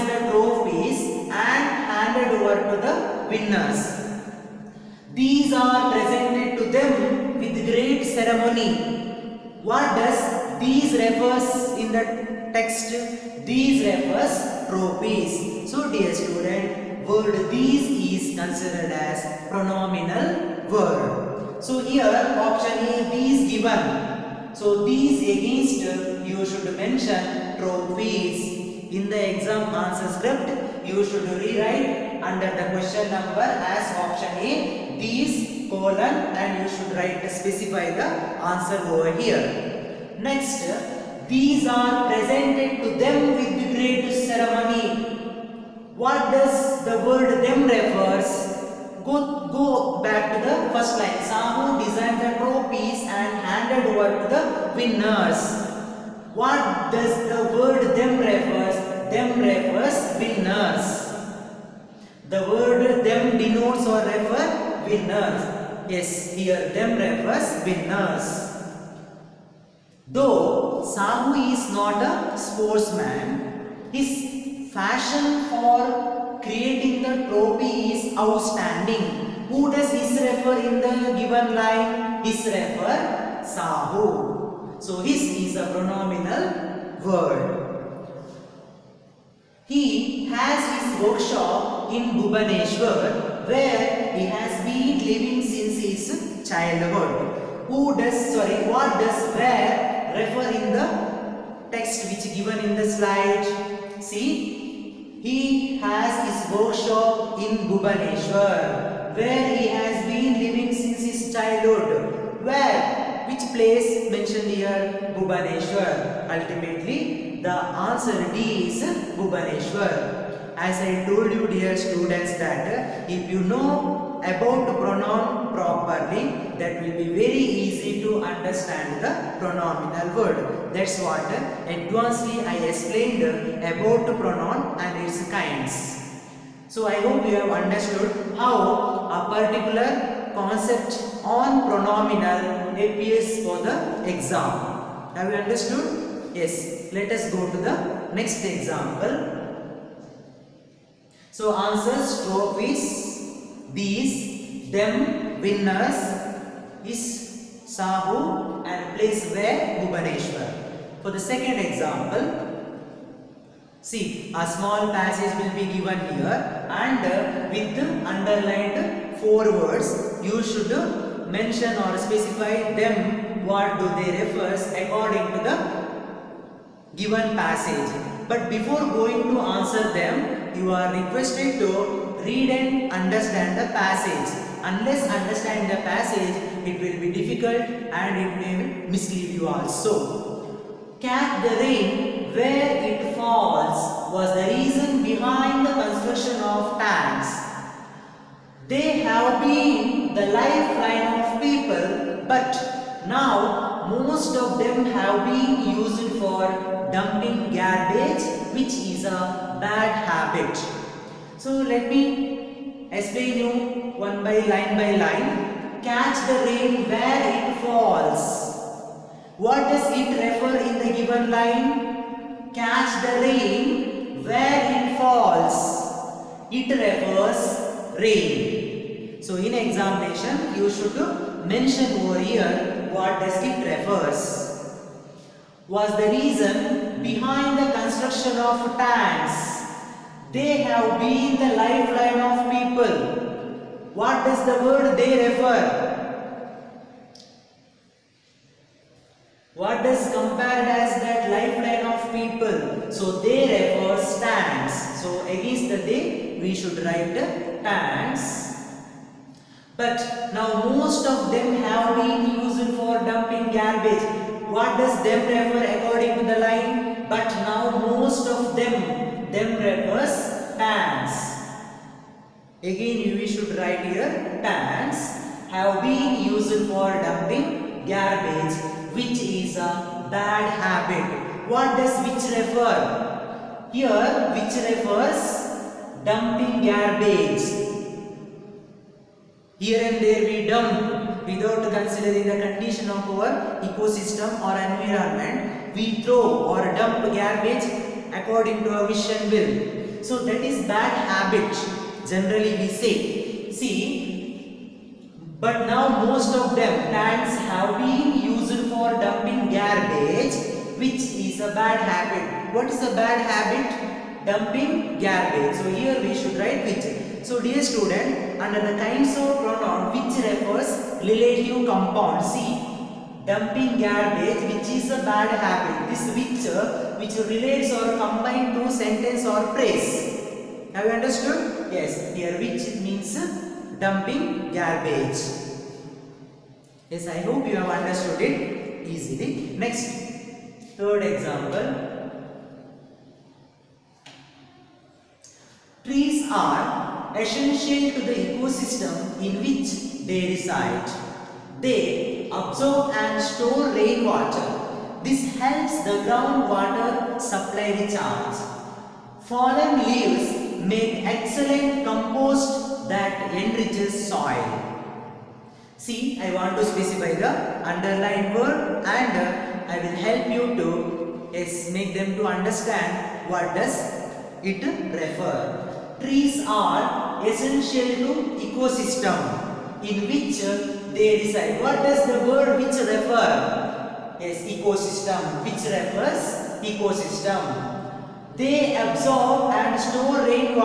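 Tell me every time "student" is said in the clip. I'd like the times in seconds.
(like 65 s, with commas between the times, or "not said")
16 s, 121 s, 317 s.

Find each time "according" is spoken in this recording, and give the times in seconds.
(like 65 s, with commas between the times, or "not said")
174 s, 265 s, 298 s.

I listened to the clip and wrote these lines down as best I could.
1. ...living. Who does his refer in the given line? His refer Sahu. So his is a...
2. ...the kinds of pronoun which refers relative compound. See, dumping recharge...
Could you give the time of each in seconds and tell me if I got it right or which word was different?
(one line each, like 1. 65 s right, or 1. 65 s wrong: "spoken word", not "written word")
1. 78 s wrong: "outstanding", not "living"
2. 318 s wrong: "garbage", not "recharge".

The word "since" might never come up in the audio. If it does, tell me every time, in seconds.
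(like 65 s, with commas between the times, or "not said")
95 s, 110 s.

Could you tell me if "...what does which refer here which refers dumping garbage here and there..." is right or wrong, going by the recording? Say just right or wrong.
right.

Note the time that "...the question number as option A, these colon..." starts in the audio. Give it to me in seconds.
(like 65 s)
32 s.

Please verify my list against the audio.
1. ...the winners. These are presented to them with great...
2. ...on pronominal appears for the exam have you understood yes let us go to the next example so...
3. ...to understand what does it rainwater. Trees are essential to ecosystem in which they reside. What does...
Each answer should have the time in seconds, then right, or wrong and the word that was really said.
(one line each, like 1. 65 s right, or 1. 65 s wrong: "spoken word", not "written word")
1. 2 s right
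2. 141 s right
3. 372 s wrong: "refer", not "rainwater".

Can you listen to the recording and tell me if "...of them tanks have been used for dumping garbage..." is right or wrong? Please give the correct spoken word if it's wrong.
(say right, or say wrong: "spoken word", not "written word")
right.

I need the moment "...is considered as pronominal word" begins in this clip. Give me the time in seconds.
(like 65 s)
17 s.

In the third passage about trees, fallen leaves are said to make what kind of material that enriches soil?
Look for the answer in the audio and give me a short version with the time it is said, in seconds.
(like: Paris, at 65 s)
excellent compost, at 361 s.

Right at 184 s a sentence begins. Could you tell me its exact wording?
Unless understand the passage, it will be difficult and it may mislead you also.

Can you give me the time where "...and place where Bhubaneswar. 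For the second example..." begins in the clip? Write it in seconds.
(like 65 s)
158 s.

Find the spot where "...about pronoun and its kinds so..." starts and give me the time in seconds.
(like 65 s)
133 s.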